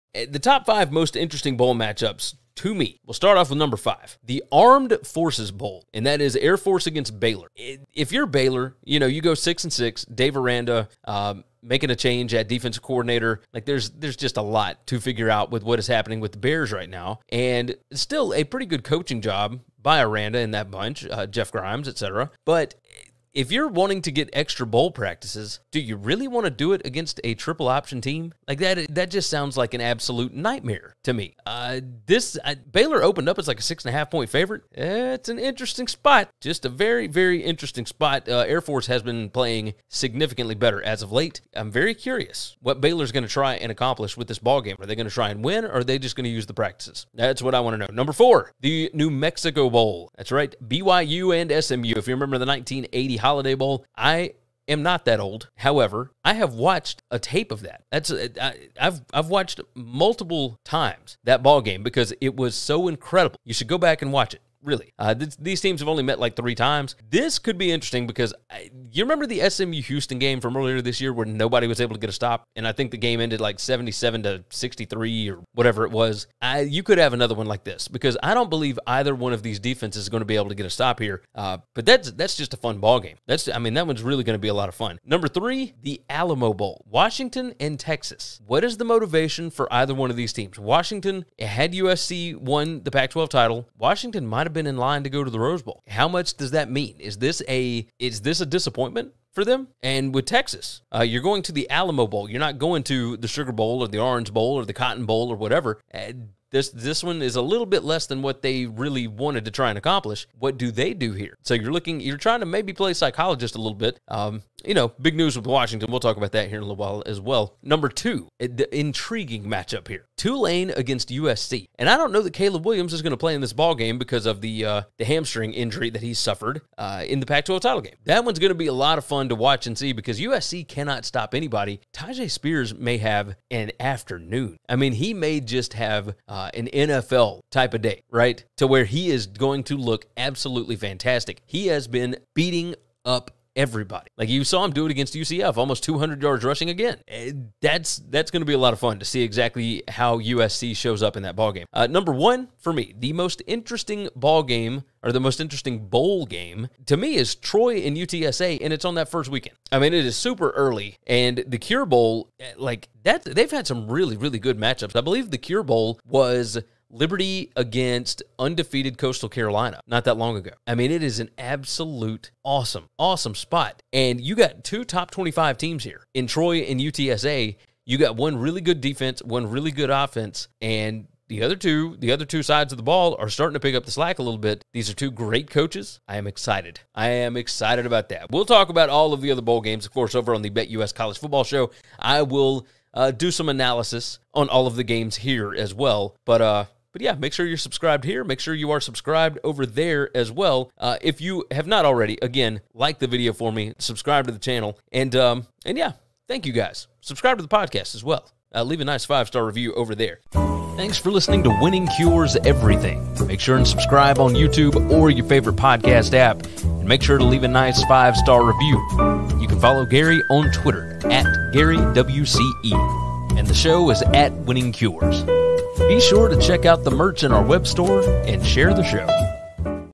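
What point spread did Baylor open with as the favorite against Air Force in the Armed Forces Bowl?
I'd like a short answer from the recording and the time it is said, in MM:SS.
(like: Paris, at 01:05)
6.5 points, at 00:33.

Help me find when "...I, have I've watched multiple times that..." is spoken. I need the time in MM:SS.
00:58.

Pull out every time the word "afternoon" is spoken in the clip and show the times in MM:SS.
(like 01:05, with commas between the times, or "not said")
02:13.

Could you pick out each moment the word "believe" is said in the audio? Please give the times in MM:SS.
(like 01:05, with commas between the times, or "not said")
01:18, 02:45.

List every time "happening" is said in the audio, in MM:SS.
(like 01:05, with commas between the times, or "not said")
00:15.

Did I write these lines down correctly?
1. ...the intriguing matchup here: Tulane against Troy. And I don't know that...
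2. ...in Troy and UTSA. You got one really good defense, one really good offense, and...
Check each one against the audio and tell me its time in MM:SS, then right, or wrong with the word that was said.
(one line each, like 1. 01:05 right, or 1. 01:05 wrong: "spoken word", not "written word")
1. 01:58 wrong: "USC", not "Troy"
2. 02:56 right.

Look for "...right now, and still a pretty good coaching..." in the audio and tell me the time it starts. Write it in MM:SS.
00:16.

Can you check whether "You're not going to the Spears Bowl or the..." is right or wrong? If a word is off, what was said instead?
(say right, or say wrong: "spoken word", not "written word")
wrong: "Sugar", not "Spears".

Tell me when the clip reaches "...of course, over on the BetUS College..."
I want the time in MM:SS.
03:09.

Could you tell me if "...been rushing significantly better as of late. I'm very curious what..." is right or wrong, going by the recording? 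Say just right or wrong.
wrong.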